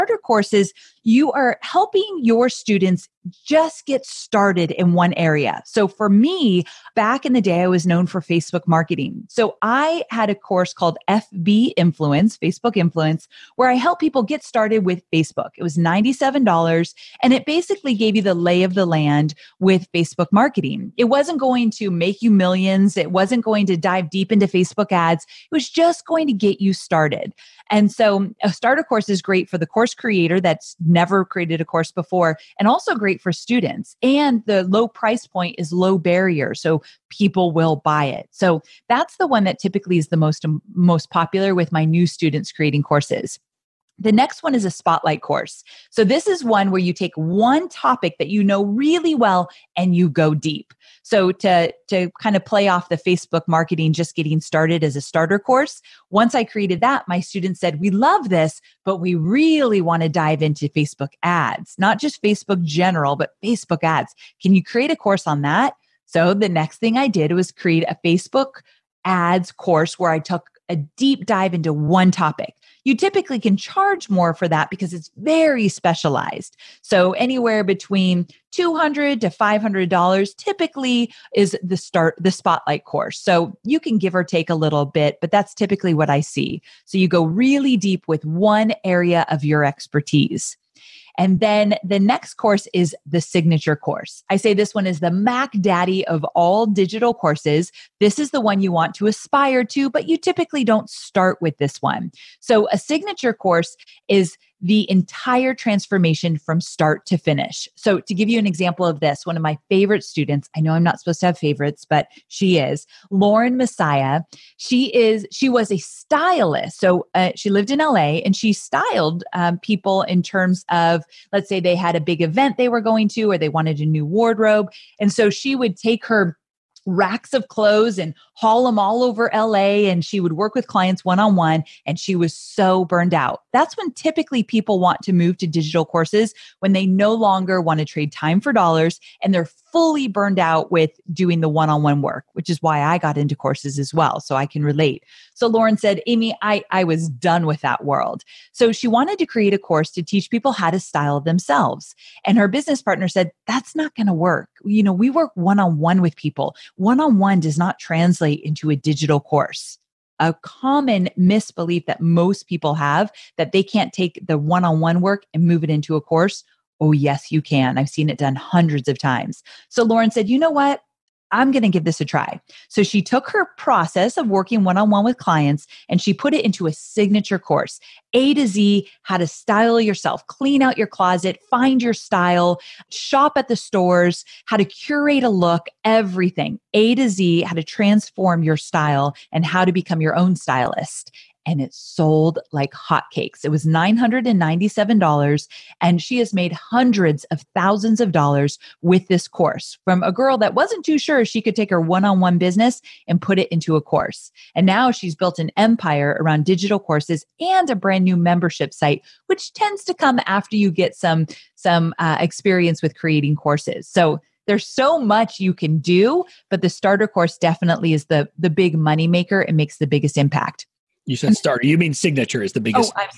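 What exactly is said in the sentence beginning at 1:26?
So you go really deep with one area of your expertise.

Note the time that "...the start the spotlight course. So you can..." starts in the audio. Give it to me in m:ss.
1:21.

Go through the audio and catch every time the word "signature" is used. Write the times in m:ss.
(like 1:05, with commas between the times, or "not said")
1:33, 1:42, 2:56, 3:41.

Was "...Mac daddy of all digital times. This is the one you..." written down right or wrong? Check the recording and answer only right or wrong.
wrong.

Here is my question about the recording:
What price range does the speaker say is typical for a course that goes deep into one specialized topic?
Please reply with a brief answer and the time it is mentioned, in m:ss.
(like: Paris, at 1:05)
$200 to $500, at 1:18.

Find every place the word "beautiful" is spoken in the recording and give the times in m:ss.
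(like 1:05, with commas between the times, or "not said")
not said.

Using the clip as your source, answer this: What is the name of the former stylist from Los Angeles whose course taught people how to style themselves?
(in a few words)
Lauren Messiah.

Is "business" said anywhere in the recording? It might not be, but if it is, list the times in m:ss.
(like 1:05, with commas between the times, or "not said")
2:32, 3:22.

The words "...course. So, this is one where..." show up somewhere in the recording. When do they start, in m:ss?
0:45.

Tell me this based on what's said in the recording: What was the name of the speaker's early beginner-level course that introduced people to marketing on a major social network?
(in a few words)
FB Influence.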